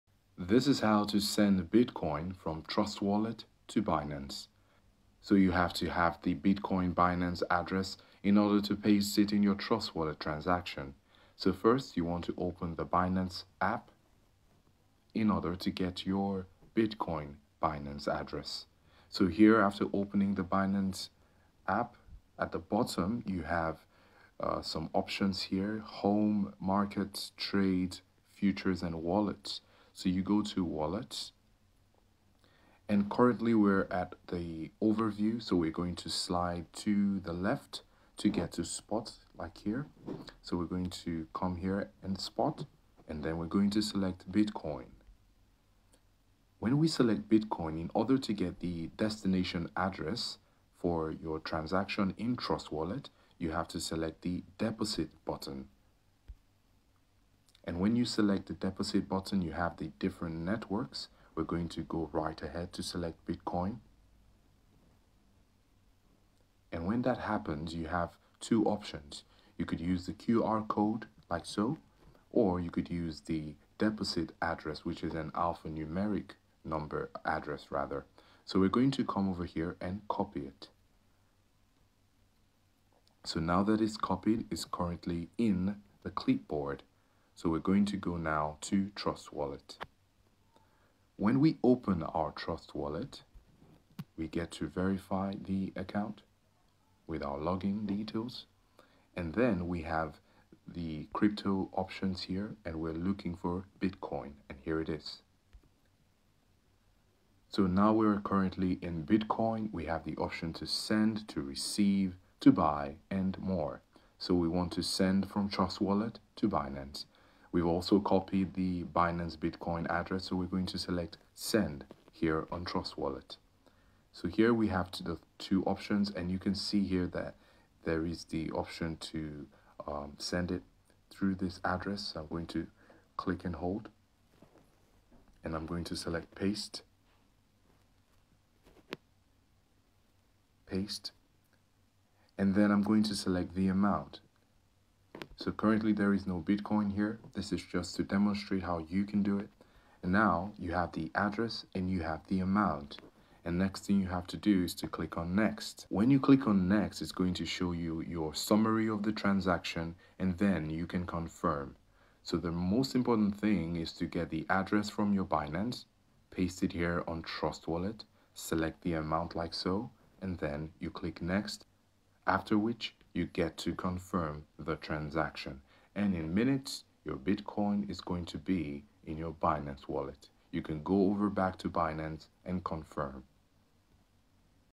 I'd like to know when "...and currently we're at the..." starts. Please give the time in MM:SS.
00:32.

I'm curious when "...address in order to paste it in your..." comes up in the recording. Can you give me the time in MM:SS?
00:07.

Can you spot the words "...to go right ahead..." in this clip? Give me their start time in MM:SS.
01:01.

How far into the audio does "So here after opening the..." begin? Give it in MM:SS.
00:19.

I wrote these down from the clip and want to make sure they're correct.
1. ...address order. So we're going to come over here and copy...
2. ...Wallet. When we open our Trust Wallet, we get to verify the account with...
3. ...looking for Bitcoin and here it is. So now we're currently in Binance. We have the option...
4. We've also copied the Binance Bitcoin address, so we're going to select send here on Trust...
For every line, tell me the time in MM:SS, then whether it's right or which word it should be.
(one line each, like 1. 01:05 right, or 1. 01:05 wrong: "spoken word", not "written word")
1. 01:17 wrong: "rather", not "order"
2. 01:29 right
3. 01:42 wrong: "Bitcoin", not "Binance"
4. 01:57 right.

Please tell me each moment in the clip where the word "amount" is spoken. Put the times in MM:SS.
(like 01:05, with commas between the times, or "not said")
02:23, 02:32, 02:48.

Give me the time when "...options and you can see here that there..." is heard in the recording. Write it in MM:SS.
02:05.